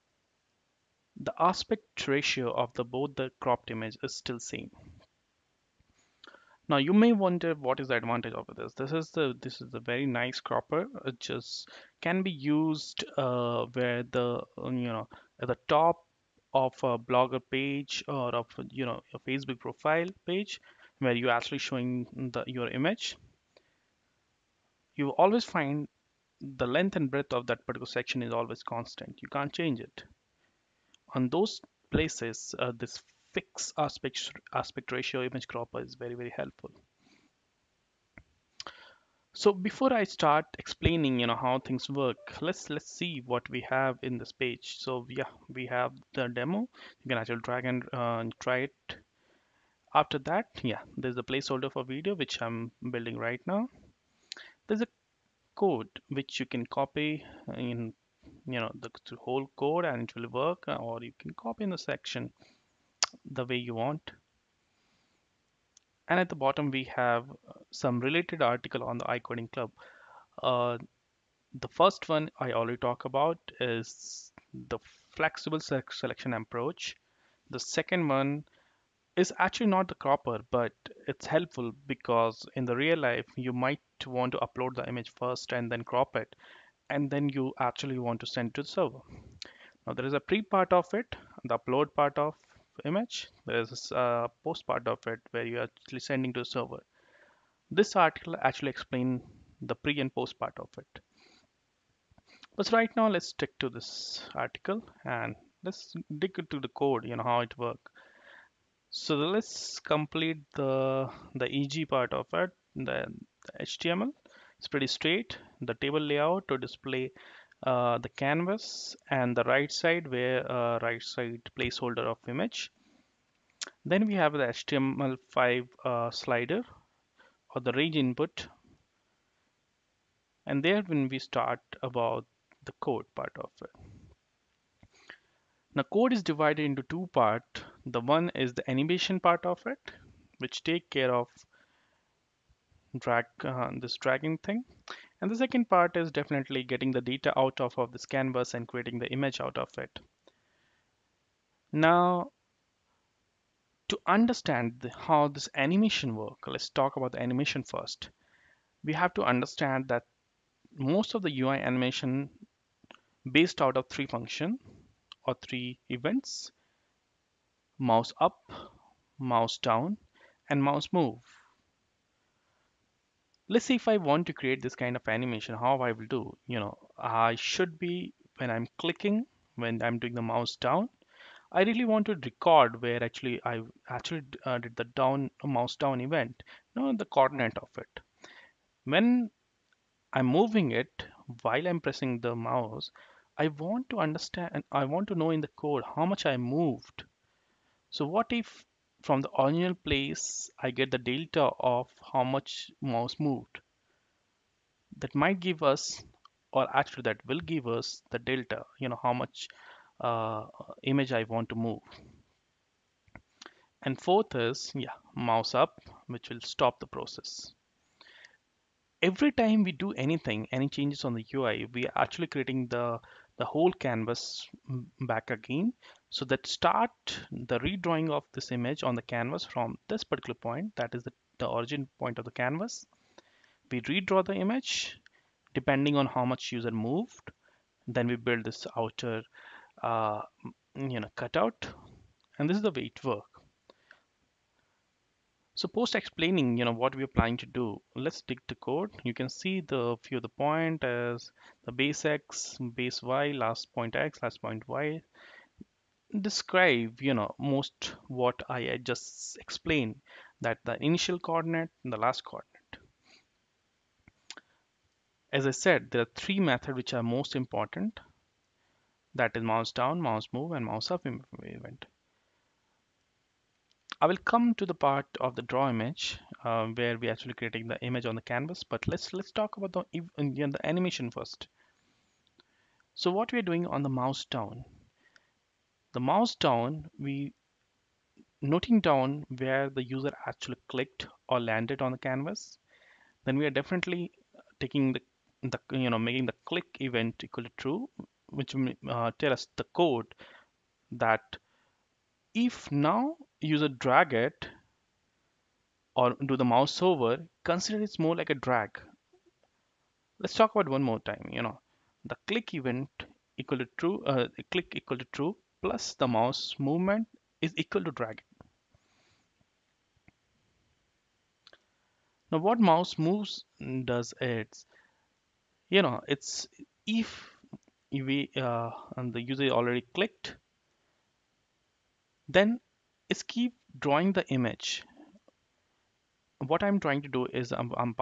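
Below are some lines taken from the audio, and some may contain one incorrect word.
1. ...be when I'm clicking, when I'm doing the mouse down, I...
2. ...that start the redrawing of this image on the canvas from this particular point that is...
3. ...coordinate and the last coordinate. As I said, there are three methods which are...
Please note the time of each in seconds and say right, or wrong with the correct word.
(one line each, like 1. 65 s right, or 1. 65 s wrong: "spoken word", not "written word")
1. 177 s right
2. 226 s right
3. 261 s right.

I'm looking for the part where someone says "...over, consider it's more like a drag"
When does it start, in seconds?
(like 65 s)
306 s.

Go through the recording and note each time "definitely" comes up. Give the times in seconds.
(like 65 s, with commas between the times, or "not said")
146 s, 293 s.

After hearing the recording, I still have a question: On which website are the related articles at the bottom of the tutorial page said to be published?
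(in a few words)
iCoding Club.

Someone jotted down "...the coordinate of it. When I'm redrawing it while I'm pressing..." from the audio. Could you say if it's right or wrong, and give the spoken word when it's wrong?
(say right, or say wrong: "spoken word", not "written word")
wrong: "moving", not "redrawing".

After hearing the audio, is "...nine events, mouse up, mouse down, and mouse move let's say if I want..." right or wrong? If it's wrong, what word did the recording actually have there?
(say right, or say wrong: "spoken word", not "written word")
wrong: "three", not "nine".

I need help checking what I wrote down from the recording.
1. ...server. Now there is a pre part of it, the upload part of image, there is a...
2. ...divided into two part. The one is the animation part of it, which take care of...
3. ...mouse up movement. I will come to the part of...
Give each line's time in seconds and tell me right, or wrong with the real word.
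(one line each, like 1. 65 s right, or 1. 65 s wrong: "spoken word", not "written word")
1. 88 s right
2. 136 s right
3. 270 s wrong: "event", not "movement".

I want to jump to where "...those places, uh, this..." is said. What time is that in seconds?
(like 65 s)
31 s.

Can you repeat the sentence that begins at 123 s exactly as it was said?
Then we have the HTML5 uh, slider or the range input.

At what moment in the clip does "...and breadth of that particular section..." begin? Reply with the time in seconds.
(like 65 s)
26 s.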